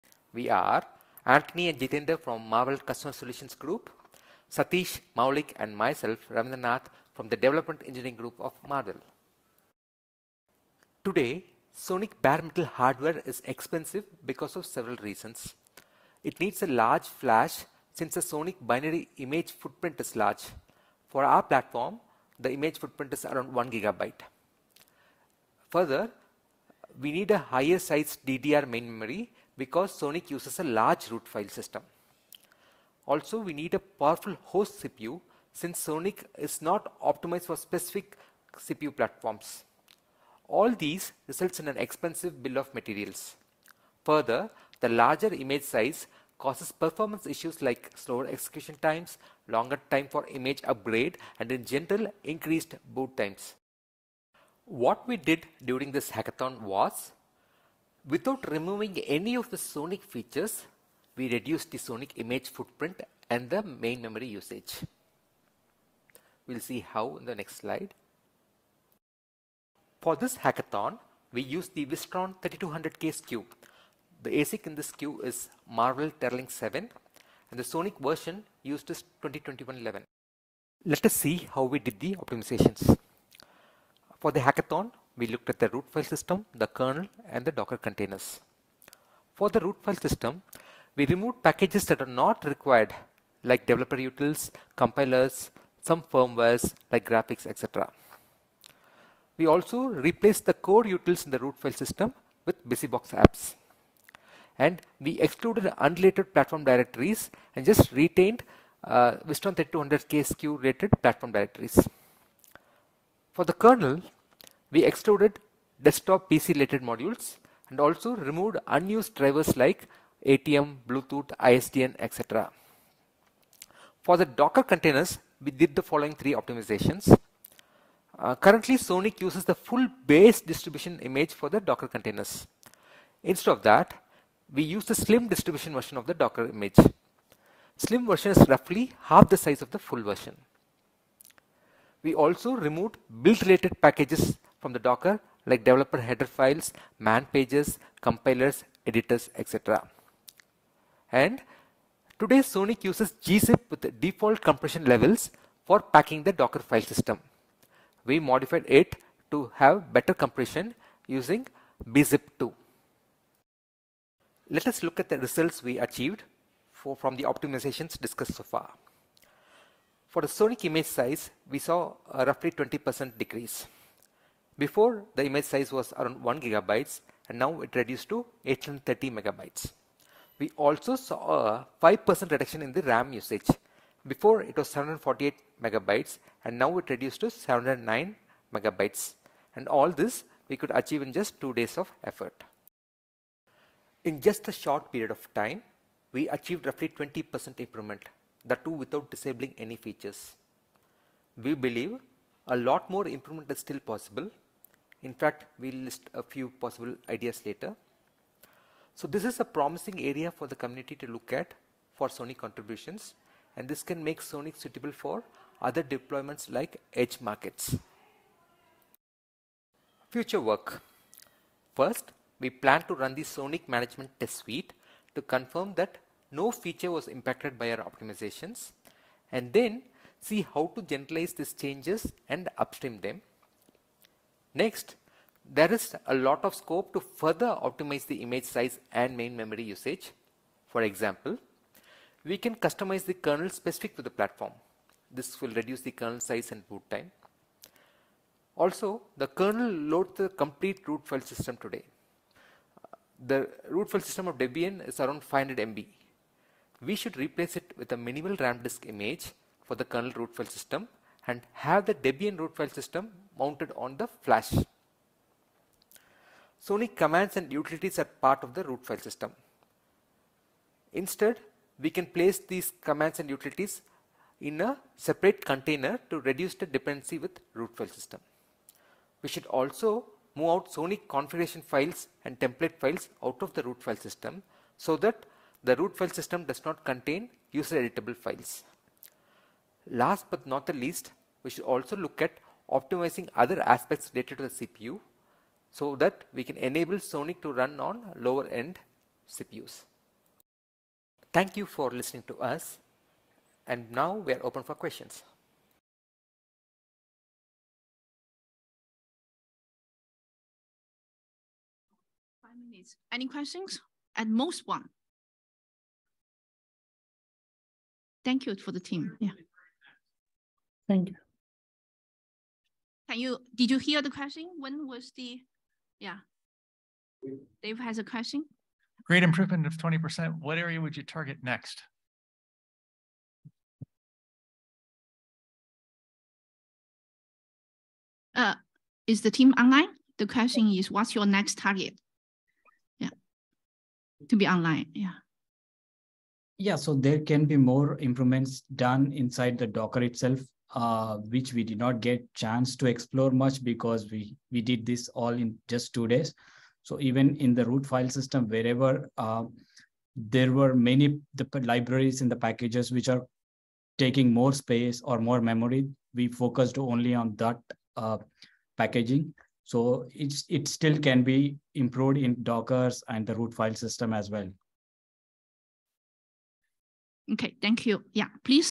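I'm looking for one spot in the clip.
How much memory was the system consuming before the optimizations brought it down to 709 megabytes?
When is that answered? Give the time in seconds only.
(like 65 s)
184 s.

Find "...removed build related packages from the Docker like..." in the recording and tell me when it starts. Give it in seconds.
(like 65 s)
142 s.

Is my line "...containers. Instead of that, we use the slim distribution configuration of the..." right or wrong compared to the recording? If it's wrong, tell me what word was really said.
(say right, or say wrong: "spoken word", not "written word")
wrong: "version", not "configuration".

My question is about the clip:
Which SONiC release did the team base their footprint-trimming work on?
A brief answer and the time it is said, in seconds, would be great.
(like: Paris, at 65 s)
2021-11, at 79 s.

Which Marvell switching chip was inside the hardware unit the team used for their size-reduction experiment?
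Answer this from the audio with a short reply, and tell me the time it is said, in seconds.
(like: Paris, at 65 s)
Teralynx 7, at 75 s.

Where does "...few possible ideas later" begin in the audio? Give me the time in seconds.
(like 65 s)
206 s.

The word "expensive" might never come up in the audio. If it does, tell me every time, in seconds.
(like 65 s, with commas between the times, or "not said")
13 s, 41 s.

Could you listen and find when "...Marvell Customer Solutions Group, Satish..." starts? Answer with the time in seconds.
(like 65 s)
2 s.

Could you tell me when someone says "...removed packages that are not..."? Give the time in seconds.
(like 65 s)
91 s.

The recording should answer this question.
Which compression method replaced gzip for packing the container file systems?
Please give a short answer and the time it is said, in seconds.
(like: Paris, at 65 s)
bzip2, at 161 s.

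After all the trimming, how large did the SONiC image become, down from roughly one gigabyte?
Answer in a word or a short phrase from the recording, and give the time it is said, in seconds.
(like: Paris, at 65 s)
830 megabytes, at 178 s.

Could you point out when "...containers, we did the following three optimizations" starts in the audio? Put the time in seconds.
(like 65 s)
124 s.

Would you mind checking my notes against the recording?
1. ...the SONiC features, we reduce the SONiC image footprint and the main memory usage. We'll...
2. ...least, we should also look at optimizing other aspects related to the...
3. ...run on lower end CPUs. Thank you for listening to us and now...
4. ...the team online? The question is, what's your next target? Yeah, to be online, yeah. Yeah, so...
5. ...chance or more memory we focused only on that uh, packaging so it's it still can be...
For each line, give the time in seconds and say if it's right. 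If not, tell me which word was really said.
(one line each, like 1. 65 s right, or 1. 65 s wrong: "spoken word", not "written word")
1. 59 s right
2. 290 s right
3. 297 s right
4. 339 s right
5. 364 s wrong: "space", not "chance".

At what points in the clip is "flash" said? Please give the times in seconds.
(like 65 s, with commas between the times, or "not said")
17 s, 264 s.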